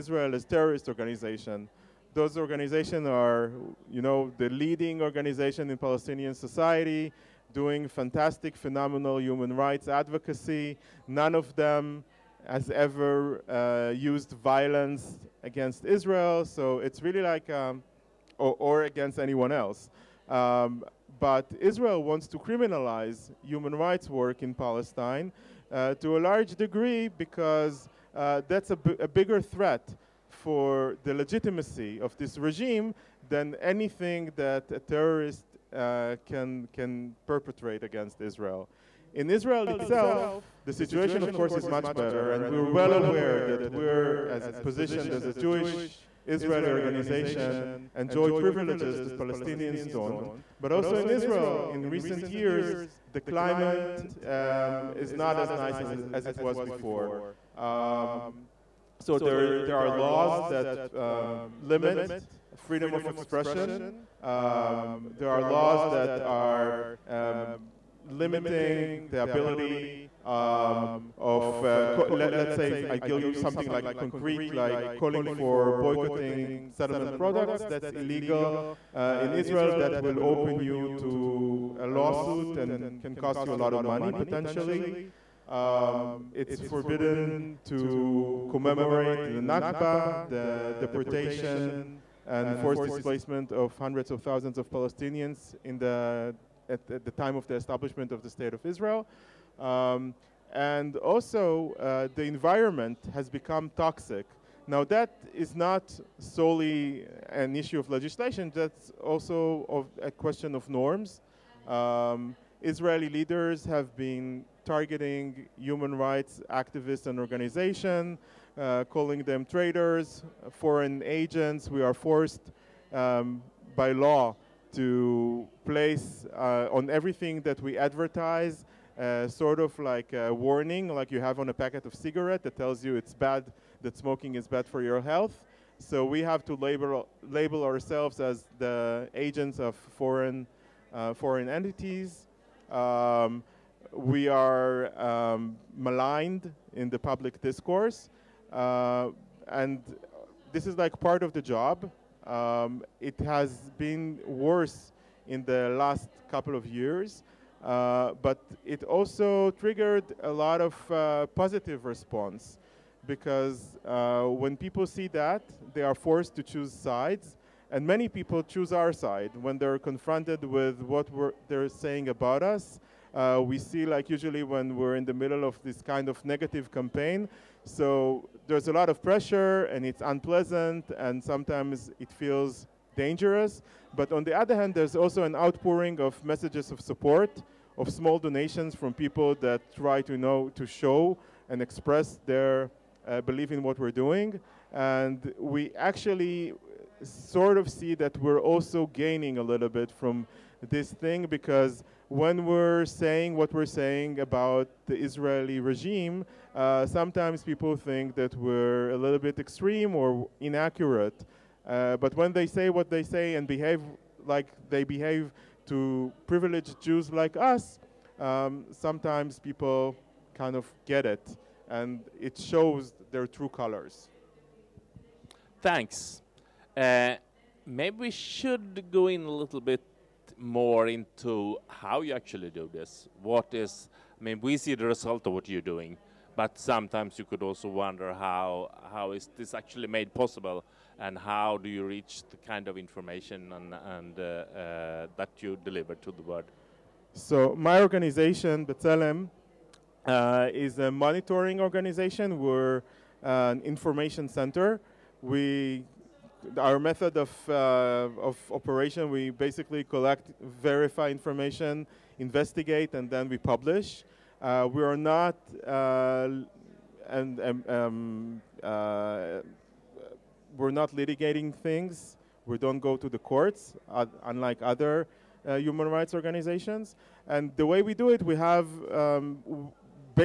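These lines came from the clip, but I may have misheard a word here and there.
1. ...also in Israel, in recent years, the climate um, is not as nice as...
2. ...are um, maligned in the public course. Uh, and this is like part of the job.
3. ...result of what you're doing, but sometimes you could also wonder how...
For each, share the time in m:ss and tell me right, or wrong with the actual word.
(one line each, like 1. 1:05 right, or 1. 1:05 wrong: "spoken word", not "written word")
1. 0:50 right
2. 2:24 wrong: "discourse", not "course"
3. 3:54 right.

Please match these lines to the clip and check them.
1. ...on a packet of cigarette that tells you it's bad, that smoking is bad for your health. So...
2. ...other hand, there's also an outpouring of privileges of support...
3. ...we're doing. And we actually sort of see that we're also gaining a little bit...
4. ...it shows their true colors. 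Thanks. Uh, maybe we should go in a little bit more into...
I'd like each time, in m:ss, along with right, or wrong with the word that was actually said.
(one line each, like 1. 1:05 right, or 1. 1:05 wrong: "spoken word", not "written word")
1. 2:11 right
2. 3:04 wrong: "messages", not "privileges"
3. 3:13 right
4. 3:42 right.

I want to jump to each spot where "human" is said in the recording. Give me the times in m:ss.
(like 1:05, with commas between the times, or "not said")
0:09, 0:23, 1:55, 4:35.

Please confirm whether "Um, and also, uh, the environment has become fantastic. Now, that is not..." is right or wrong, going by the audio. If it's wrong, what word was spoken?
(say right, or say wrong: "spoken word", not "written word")
wrong: "toxic", not "fantastic".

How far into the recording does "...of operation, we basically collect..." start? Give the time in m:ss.
4:18.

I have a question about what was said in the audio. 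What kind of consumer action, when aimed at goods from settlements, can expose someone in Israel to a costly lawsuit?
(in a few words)
Boycotting.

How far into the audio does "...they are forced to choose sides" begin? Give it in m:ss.
2:45.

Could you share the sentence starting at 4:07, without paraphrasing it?
So my organization, B'Tselem, uh, is a monitoring organization.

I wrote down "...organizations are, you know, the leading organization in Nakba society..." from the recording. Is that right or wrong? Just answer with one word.
wrong.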